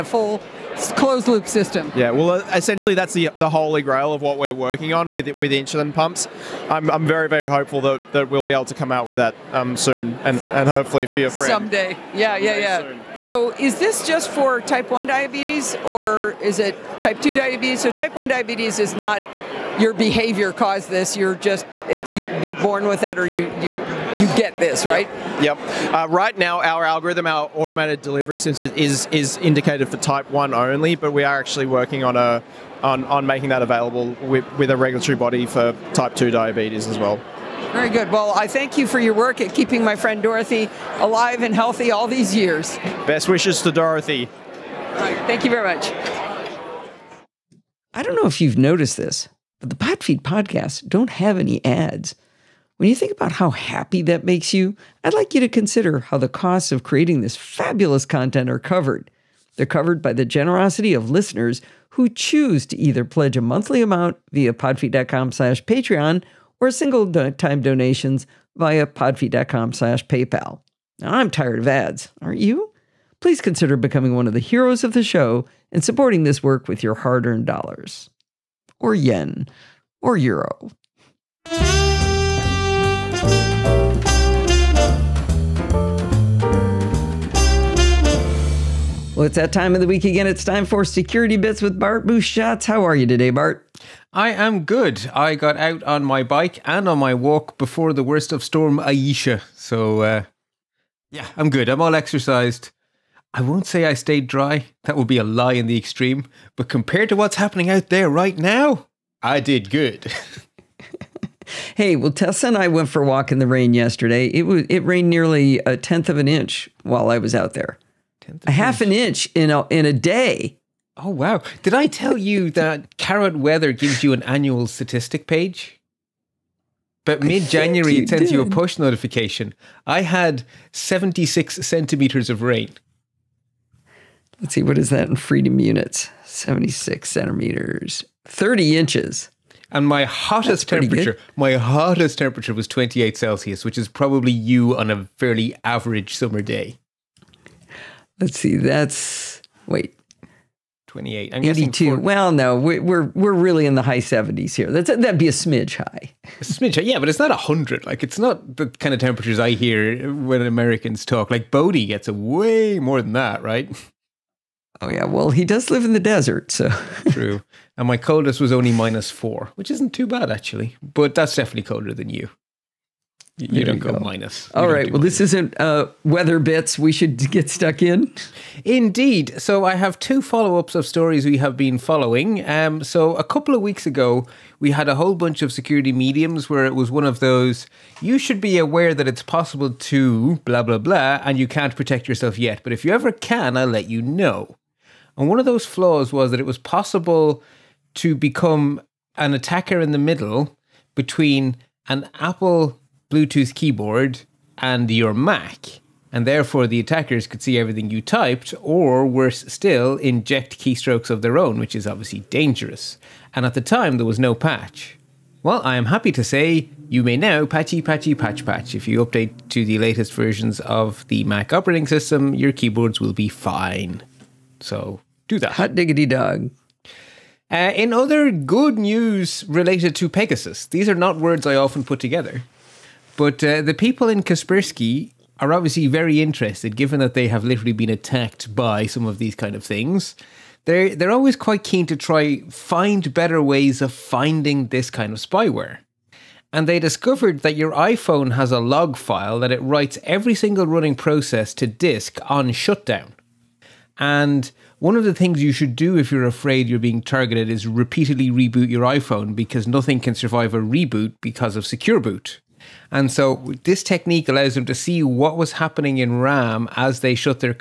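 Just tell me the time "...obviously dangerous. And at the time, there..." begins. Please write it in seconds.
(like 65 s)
211 s.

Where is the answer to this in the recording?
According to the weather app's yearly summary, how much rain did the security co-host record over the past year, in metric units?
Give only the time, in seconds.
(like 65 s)
130 s.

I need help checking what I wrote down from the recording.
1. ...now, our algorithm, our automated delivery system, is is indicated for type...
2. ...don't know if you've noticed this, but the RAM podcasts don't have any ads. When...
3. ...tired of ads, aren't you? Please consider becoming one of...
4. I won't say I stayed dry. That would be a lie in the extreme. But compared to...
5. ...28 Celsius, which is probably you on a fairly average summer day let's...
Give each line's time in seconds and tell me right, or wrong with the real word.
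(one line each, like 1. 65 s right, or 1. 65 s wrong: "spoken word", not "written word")
1. 26 s right
2. 48 s wrong: "Podfeet", not "RAM"
3. 71 s right
4. 103 s right
5. 142 s right.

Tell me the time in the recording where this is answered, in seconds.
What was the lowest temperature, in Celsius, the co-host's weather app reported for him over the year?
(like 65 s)
168 s.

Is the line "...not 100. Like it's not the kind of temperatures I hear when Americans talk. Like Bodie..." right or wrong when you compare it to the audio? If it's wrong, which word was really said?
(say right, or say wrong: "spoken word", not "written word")
right.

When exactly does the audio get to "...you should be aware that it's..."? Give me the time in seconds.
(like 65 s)
188 s.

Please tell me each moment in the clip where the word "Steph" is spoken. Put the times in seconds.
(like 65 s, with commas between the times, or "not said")
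not said.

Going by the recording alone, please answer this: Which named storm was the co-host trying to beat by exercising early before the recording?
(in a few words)
Storm Isha.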